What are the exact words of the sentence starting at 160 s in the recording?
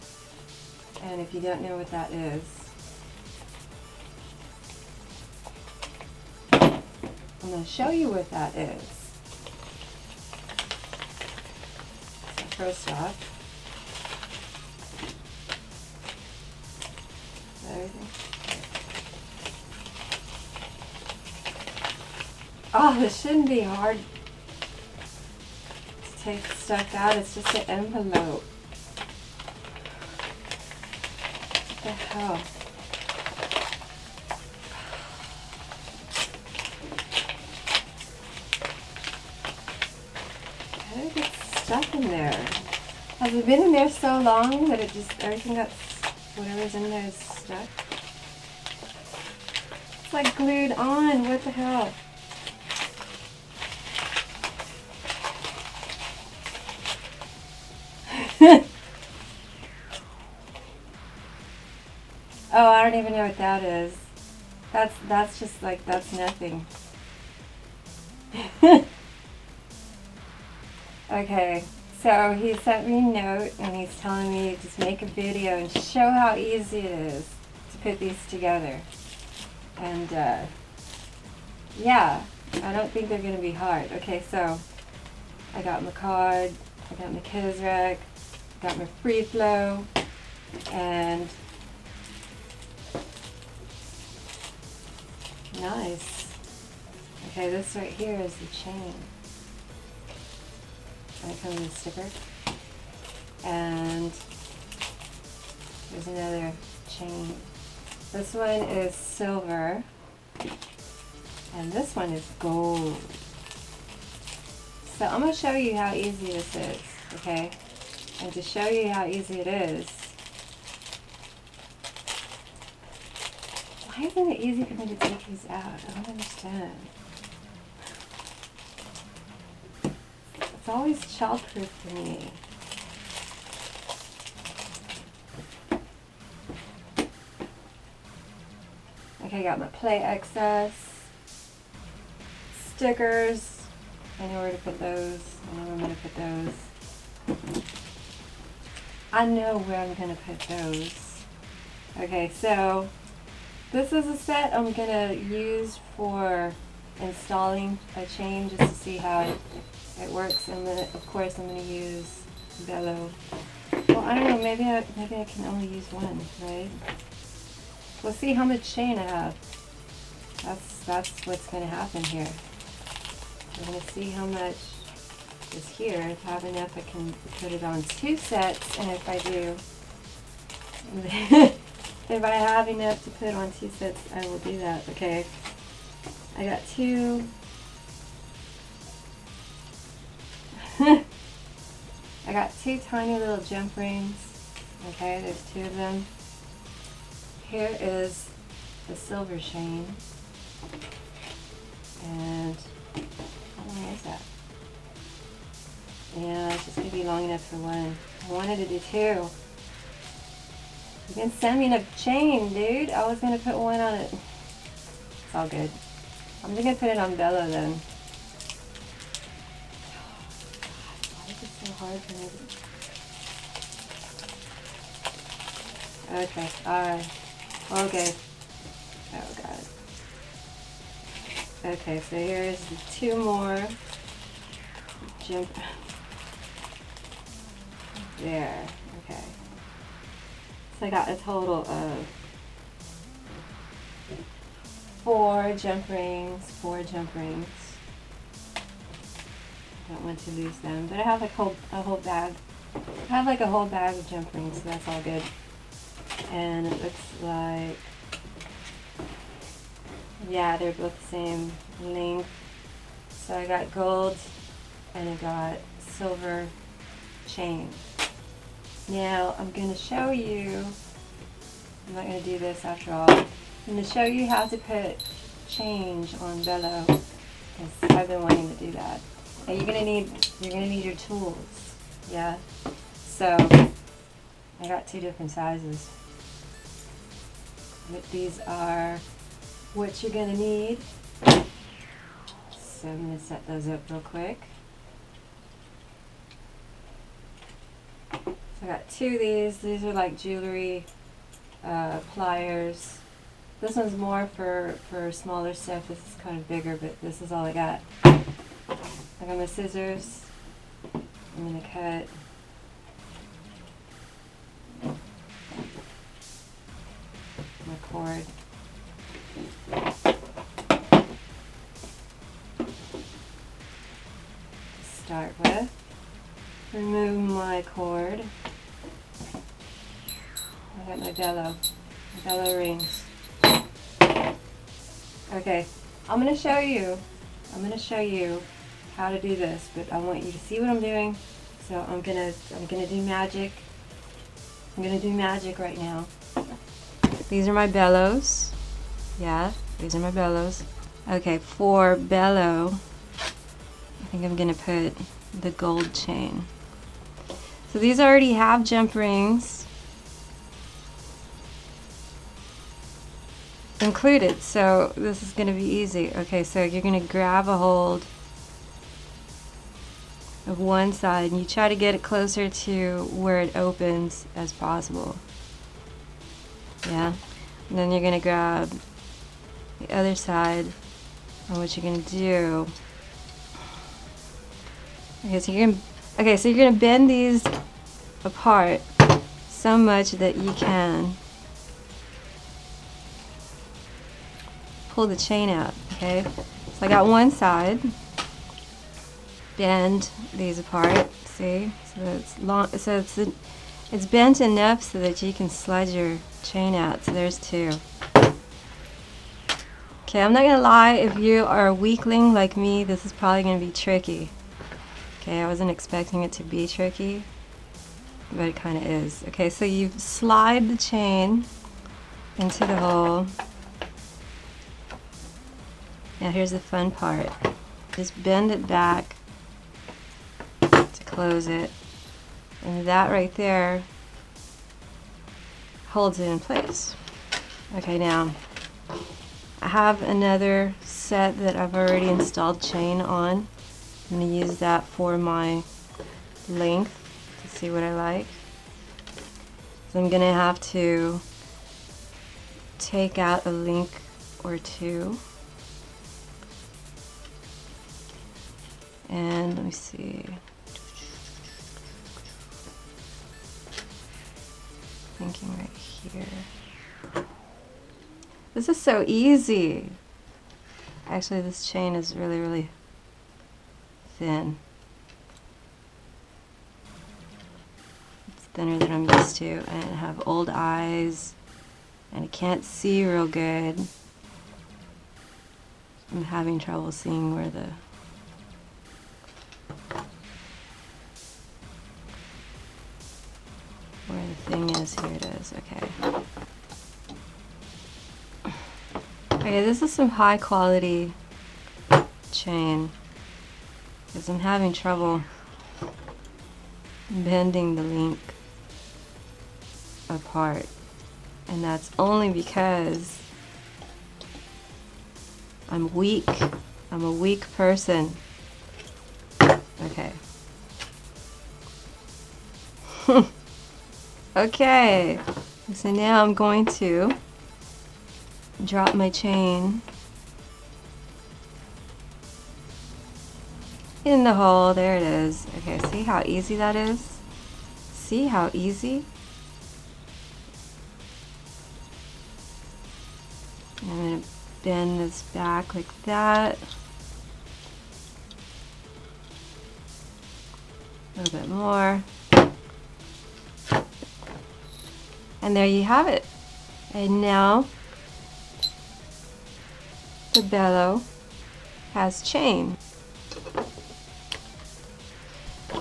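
And then, of course, I'm going to use Belo.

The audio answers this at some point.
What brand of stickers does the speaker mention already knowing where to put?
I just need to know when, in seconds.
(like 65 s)
139 s.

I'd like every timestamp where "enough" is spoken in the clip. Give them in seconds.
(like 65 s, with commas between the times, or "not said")
176 s, 182 s, 207 s, 404 s.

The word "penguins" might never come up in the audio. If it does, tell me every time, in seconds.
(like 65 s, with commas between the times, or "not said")
not said.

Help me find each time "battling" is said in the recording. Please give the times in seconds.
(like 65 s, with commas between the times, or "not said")
not said.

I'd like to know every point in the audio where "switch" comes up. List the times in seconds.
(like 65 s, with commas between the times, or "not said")
not said.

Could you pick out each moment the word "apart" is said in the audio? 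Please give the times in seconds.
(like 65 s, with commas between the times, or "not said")
388 s, 400 s, 510 s.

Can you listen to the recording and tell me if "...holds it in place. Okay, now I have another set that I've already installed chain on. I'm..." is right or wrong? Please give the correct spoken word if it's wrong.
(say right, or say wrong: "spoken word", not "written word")
right.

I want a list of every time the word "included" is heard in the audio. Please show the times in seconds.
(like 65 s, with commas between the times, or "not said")
363 s.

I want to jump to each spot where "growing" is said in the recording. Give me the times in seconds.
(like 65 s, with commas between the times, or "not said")
not said.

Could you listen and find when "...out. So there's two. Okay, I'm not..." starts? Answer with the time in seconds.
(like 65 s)
406 s.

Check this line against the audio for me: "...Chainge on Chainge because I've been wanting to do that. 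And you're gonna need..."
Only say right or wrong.
wrong.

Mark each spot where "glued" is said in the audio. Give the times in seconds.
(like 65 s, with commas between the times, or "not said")
50 s.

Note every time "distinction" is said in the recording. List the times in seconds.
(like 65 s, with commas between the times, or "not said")
not said.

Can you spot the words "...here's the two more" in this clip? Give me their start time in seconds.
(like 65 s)
232 s.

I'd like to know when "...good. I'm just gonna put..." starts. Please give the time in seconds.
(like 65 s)
215 s.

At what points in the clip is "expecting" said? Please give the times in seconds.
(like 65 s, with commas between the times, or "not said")
415 s.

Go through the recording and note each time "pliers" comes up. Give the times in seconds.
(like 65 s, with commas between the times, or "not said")
302 s.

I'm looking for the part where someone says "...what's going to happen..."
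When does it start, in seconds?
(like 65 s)
171 s.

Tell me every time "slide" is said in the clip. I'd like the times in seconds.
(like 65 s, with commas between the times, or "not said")
405 s, 419 s.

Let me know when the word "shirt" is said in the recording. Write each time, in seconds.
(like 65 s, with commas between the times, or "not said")
not said.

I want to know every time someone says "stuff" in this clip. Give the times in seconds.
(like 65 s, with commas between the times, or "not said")
26 s, 41 s, 305 s.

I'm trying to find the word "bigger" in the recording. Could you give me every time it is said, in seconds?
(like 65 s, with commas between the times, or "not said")
306 s.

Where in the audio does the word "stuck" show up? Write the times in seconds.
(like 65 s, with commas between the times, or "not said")
47 s.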